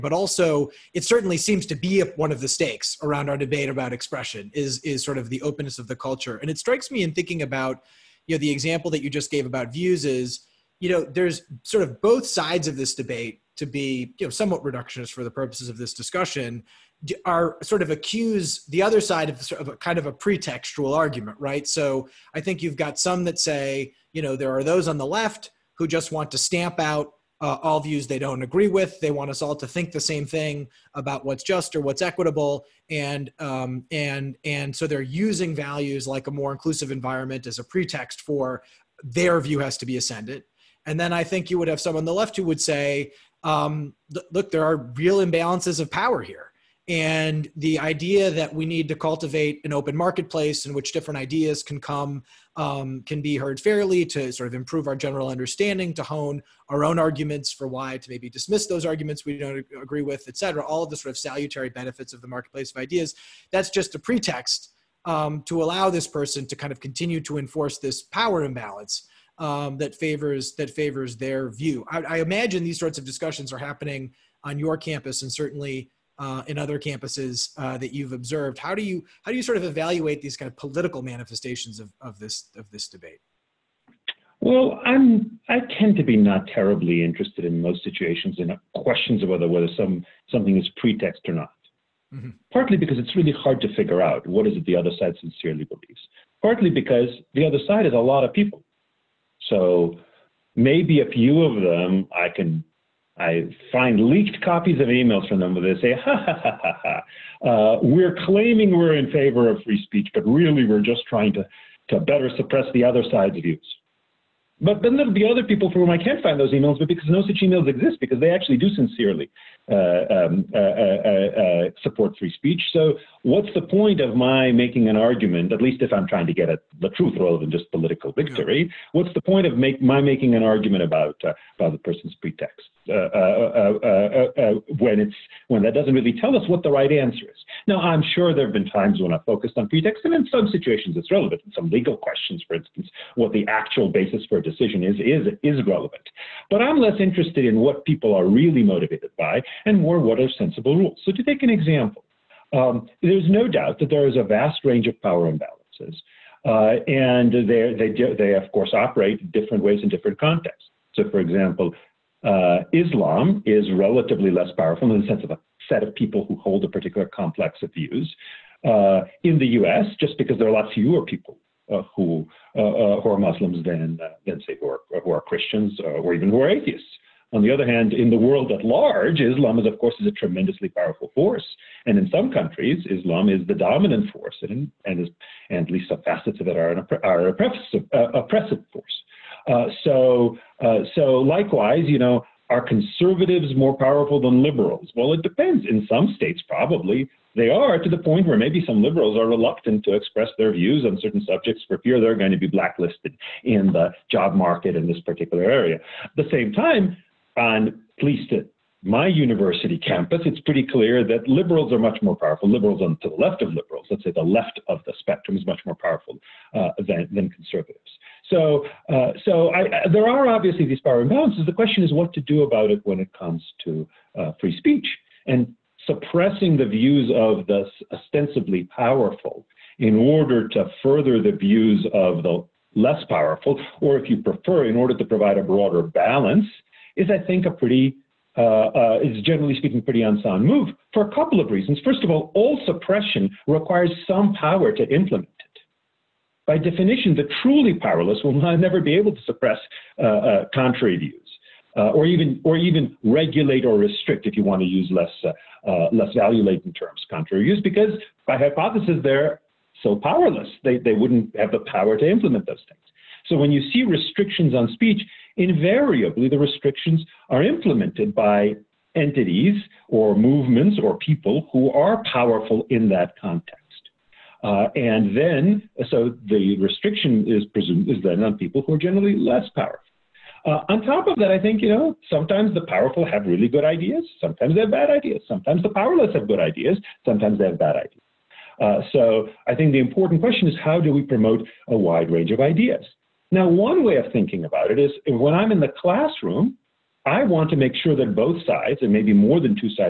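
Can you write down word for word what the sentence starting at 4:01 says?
First of all, all suppression requires some power to implement it.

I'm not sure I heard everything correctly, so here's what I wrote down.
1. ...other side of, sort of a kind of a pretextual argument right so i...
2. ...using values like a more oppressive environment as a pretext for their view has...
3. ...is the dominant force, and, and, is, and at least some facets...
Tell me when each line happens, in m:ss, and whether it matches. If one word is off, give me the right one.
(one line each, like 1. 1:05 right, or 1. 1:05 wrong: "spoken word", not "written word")
1. 0:18 right
2. 0:35 wrong: "inclusive", not "oppressive"
3. 3:03 right.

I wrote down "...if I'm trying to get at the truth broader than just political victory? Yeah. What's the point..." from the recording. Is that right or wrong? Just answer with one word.
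wrong.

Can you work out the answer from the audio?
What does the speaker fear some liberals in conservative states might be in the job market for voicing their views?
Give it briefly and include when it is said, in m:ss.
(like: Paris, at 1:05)
blacklisted, at 3:22.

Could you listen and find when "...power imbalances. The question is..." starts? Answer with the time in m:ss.
3:40.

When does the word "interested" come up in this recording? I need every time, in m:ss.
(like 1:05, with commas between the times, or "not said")
1:27, 2:26.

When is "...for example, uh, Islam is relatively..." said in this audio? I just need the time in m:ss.
2:41.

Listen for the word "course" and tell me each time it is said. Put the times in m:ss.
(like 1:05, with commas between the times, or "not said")
2:38, 2:59.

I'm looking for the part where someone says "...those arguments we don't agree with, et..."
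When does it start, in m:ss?
0:58.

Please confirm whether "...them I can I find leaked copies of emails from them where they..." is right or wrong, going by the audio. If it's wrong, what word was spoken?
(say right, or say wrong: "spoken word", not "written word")
right.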